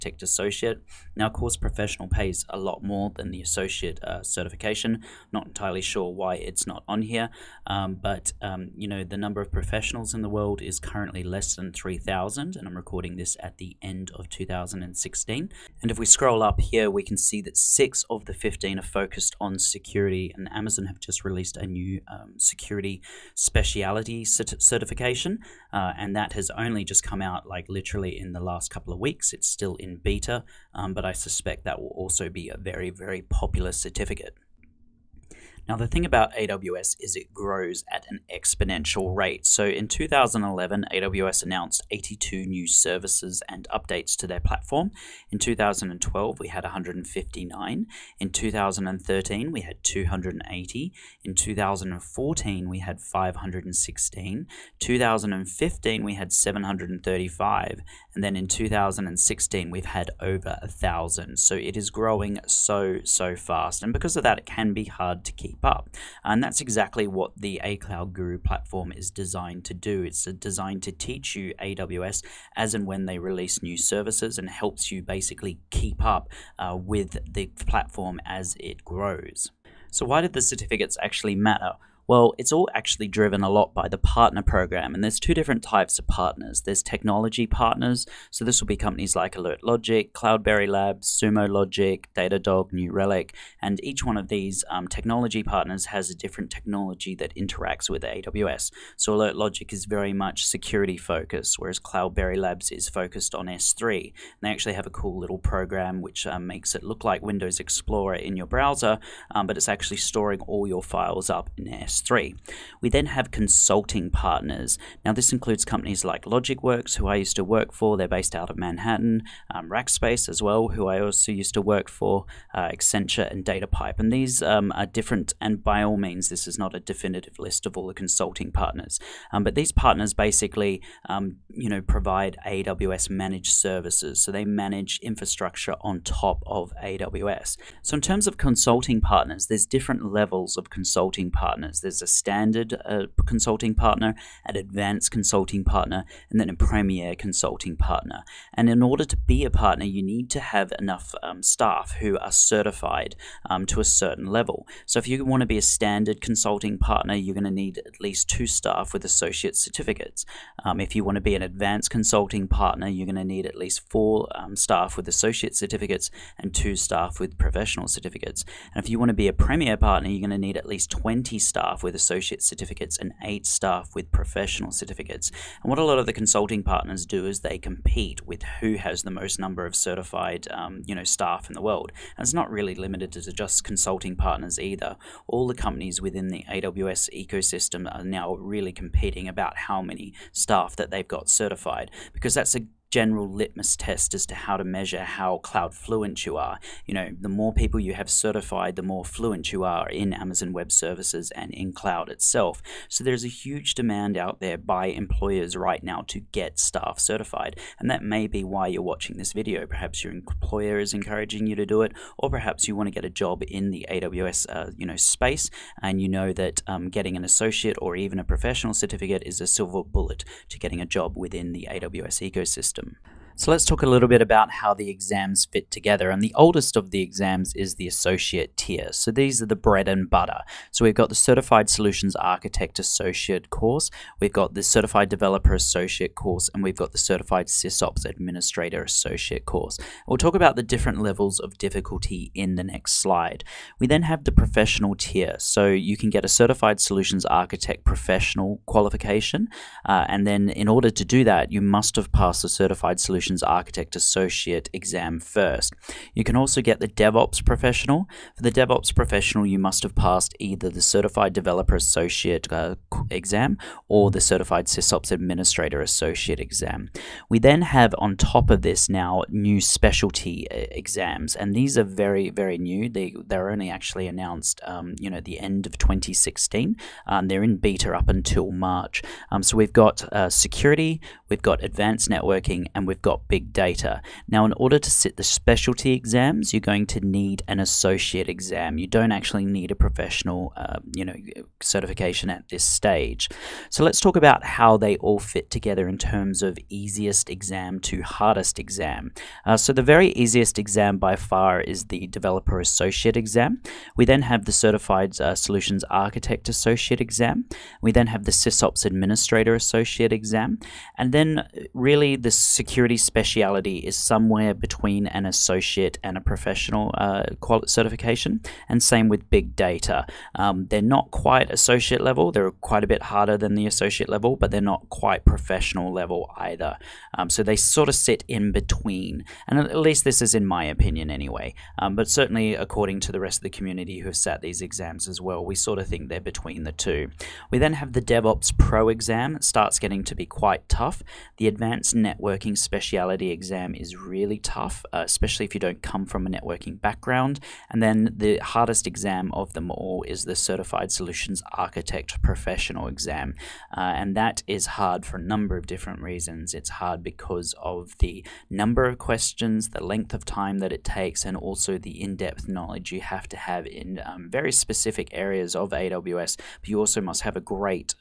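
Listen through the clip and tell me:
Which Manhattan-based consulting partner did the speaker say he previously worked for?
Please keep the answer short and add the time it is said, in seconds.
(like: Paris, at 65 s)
LogicWorks, at 116 s.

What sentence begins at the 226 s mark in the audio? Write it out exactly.
And the oldest of the exams is the associate tier.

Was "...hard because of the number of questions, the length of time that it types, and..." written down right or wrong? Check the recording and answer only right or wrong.
wrong.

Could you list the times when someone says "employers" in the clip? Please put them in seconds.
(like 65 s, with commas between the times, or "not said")
204 s, 210 s.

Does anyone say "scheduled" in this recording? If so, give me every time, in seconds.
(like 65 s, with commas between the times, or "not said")
not said.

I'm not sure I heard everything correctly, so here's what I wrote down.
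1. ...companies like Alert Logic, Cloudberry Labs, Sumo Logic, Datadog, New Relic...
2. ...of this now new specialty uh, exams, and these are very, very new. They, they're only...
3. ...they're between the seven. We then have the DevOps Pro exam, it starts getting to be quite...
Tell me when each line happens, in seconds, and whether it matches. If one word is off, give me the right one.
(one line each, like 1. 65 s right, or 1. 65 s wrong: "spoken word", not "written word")
1. 88 s right
2. 268 s right
3. 336 s wrong: "two", not "seven".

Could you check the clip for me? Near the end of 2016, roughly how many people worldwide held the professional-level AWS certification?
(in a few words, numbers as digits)
less than 3,000.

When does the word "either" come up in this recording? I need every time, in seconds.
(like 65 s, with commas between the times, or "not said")
184 s, 260 s, 326 s.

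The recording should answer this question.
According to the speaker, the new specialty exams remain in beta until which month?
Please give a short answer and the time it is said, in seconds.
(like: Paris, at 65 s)
March, at 278 s.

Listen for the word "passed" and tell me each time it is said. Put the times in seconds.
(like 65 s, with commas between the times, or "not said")
252 s, 259 s.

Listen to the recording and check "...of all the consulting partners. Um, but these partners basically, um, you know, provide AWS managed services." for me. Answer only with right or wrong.
right.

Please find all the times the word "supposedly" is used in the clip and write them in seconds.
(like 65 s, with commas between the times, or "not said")
not said.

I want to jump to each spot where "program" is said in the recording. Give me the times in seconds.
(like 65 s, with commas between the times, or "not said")
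84 s, 105 s.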